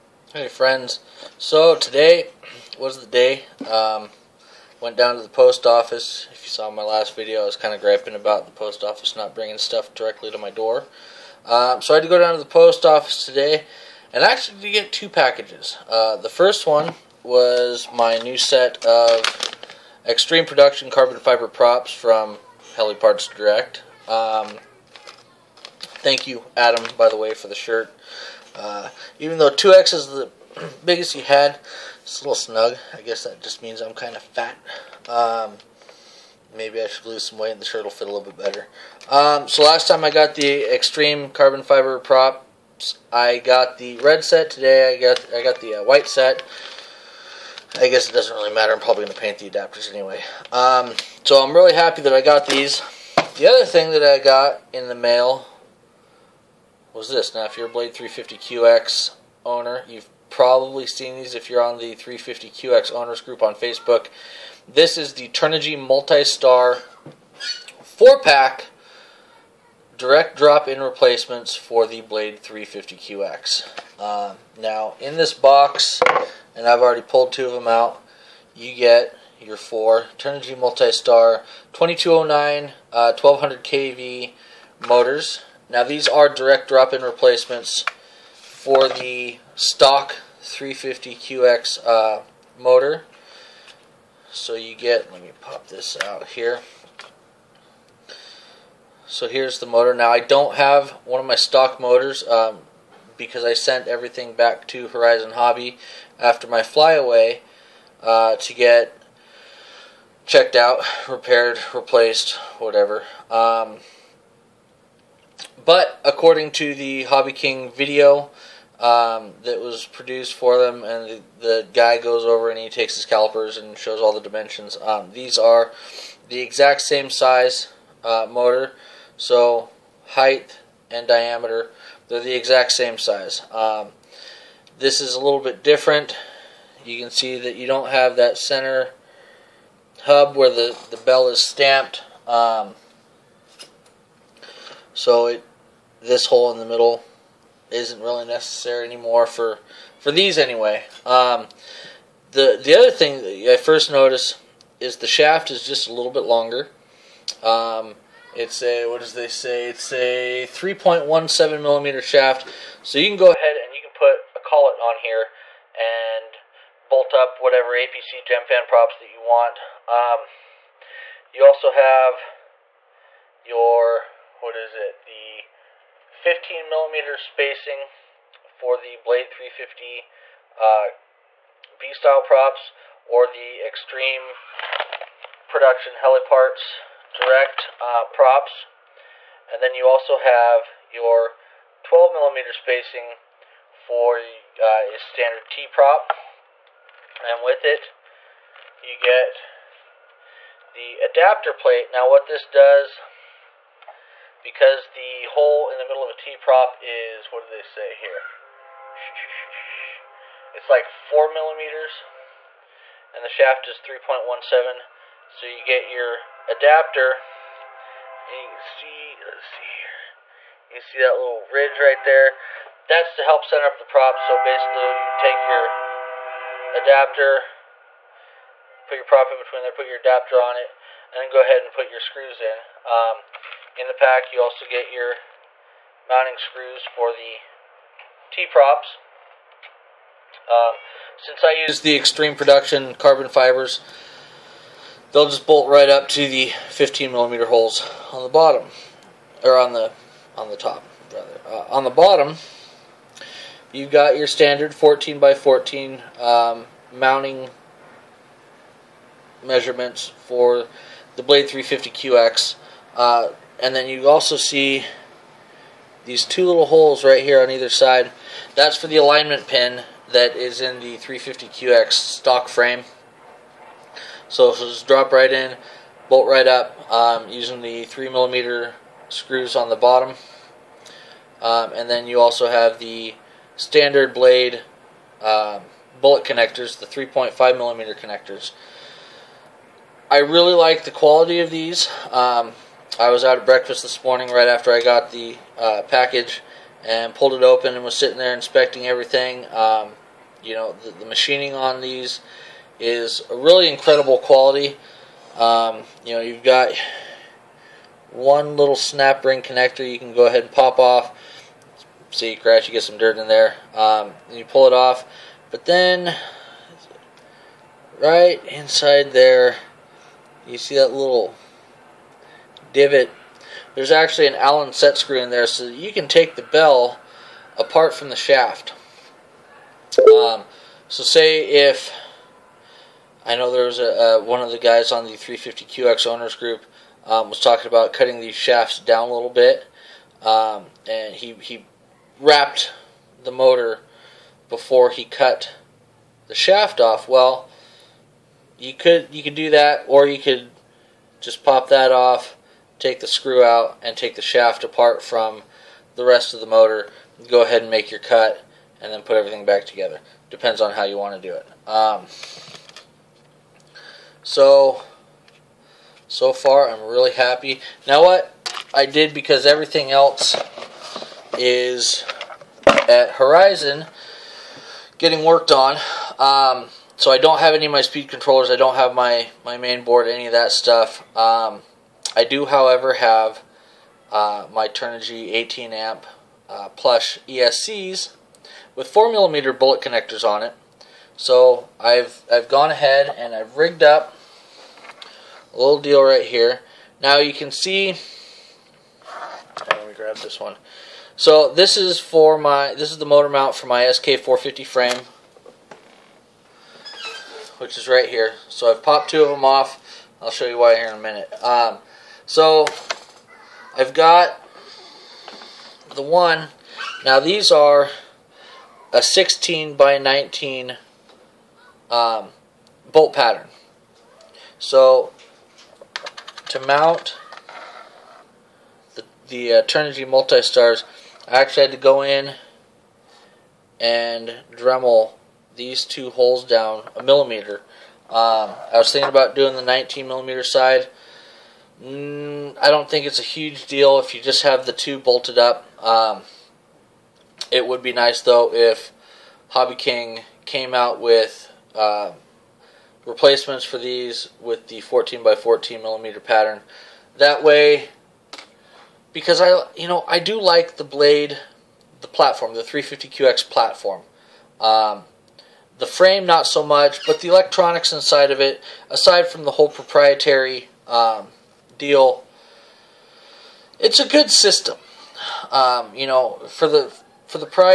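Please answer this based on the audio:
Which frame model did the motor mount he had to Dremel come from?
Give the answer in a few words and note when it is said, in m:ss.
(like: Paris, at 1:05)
SK450, at 6:43.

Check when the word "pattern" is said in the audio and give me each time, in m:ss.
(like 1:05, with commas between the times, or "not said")
7:03, 7:36.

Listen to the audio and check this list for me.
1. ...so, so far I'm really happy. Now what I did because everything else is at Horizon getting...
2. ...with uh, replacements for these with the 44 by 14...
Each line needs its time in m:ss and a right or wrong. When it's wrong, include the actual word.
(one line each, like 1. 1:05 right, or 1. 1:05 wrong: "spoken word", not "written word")
1. 6:04 right
2. 7:31 wrong: "14", not "44".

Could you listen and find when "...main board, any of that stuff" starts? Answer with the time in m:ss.
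6:19.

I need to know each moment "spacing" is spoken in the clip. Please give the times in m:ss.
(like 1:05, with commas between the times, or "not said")
2:57, 3:12.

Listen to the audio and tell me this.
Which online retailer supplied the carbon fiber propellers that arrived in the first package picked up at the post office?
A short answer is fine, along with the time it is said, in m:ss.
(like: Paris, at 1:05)
Heli Parts Direct, at 0:22.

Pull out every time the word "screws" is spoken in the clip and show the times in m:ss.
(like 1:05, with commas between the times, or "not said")
3:51, 3:56, 4:39, 5:24, 5:53.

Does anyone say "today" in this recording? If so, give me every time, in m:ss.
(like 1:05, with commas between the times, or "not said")
0:01, 0:13, 0:44.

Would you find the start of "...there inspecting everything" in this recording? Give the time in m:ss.
4:58.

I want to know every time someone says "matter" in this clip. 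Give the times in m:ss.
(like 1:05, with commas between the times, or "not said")
0:48.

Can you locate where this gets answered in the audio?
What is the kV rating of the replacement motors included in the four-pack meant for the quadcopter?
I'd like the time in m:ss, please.
1:23.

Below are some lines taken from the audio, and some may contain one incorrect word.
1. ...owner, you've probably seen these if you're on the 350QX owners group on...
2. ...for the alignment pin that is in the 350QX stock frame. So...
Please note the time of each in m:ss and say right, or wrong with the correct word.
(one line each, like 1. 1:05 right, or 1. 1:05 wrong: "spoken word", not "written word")
1. 0:59 right
2. 4:28 right.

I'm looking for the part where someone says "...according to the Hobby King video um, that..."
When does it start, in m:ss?
1:56.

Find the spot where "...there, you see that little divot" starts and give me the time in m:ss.
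5:19.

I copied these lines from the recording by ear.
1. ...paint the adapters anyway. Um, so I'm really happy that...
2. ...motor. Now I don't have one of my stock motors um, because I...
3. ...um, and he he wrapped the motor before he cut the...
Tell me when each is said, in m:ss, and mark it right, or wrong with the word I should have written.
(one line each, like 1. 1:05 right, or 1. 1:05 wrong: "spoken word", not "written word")
1. 0:49 right
2. 1:39 right
3. 5:40 right.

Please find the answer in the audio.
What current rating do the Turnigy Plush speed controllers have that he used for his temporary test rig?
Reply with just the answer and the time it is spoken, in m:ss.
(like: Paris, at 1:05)
18 amp, at 6:25.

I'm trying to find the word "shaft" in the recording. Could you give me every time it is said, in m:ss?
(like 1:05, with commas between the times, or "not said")
2:35, 2:42, 3:33, 5:28, 5:38, 5:46, 5:54.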